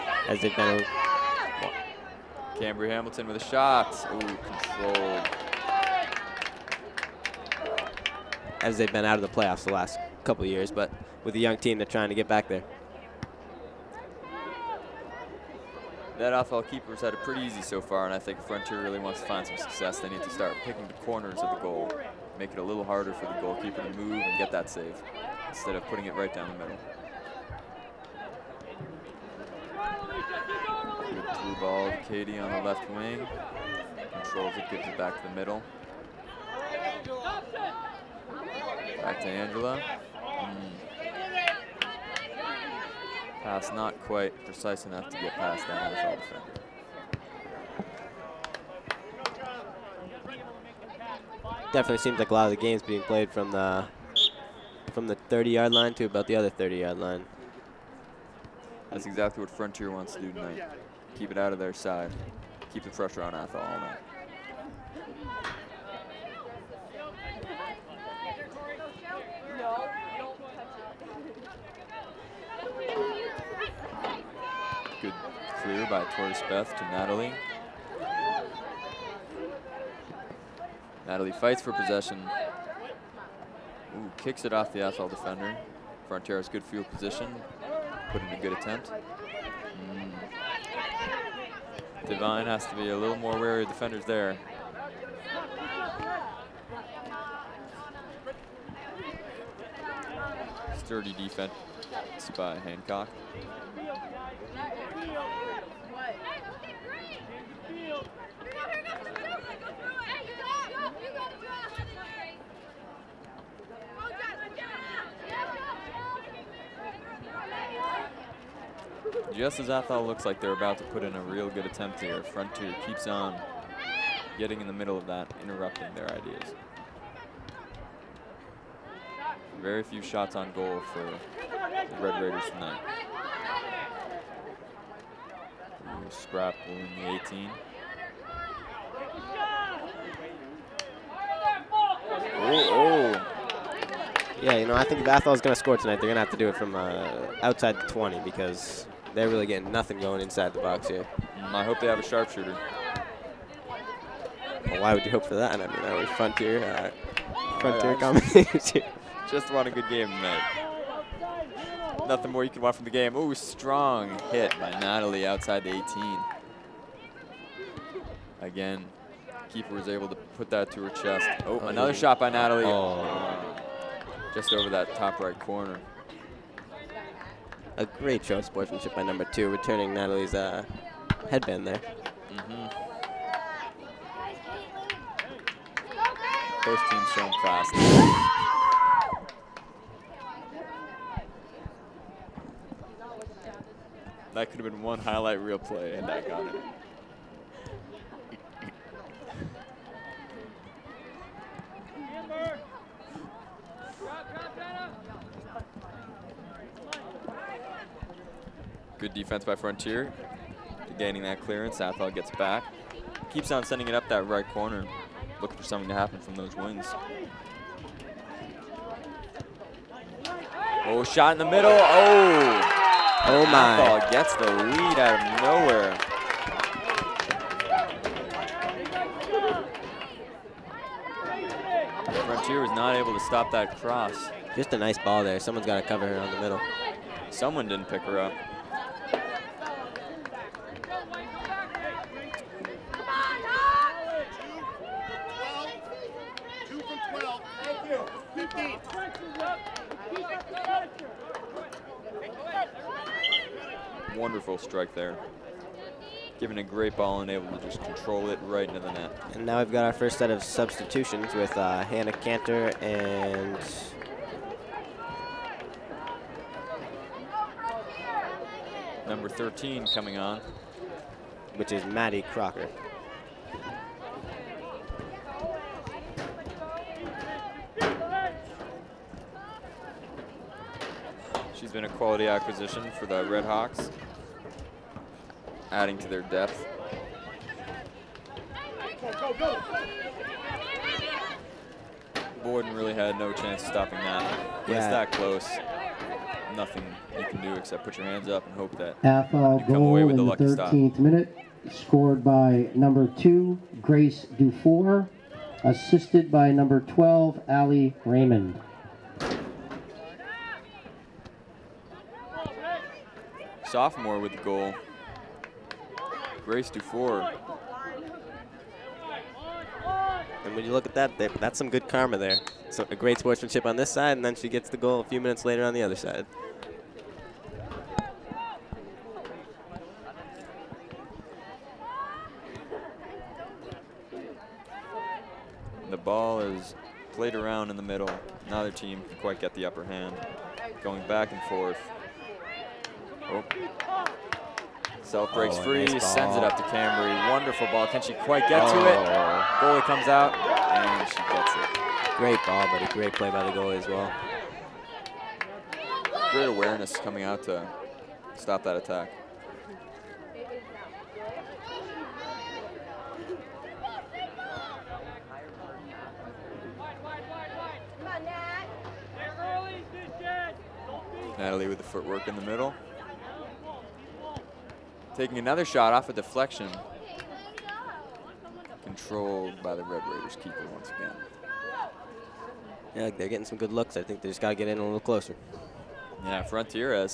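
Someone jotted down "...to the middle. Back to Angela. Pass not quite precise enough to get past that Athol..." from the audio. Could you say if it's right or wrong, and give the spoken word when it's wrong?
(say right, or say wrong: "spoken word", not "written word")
right.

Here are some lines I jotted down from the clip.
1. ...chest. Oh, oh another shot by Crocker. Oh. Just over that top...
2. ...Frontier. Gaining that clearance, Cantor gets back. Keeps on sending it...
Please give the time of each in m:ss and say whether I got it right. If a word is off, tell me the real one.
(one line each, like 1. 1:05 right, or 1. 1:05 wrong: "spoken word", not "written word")
1. 2:50 wrong: "Natalie", not "Crocker"
2. 3:29 wrong: "Athol", not "Cantor".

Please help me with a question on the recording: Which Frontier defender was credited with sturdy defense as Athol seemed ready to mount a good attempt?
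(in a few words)
Hancock.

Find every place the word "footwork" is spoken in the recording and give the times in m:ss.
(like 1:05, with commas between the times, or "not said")
6:11.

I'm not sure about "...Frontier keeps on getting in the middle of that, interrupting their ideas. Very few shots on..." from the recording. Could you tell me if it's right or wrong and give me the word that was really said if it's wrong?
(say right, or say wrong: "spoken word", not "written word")
right.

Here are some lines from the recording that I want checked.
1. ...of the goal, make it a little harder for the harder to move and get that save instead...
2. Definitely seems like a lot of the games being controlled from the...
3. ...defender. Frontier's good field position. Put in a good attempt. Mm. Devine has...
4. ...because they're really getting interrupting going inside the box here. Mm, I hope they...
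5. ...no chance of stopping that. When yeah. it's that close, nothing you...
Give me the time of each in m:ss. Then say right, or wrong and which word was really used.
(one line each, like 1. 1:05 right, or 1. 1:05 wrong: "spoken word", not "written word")
1. 0:21 wrong: "goalkeeper", not "harder"
2. 0:51 wrong: "played", not "controlled"
3. 1:25 right
4. 2:28 wrong: "nothing", not "interrupting"
5. 4:53 right.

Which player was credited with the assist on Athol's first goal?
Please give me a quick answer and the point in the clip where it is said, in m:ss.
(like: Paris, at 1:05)
Ali Raymond, at 5:07.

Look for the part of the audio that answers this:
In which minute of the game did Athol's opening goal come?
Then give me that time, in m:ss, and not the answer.
5:00.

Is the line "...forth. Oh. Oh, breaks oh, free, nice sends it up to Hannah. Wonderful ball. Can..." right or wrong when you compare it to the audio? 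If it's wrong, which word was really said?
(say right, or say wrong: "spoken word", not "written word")
wrong: "Cambry", not "Hannah".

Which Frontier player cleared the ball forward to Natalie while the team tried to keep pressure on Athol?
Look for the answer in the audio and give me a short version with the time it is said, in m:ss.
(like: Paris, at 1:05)
Tori Speth, at 1:16.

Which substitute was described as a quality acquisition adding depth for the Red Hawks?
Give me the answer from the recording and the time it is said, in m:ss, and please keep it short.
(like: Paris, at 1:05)
Maddie Crocker, at 4:31.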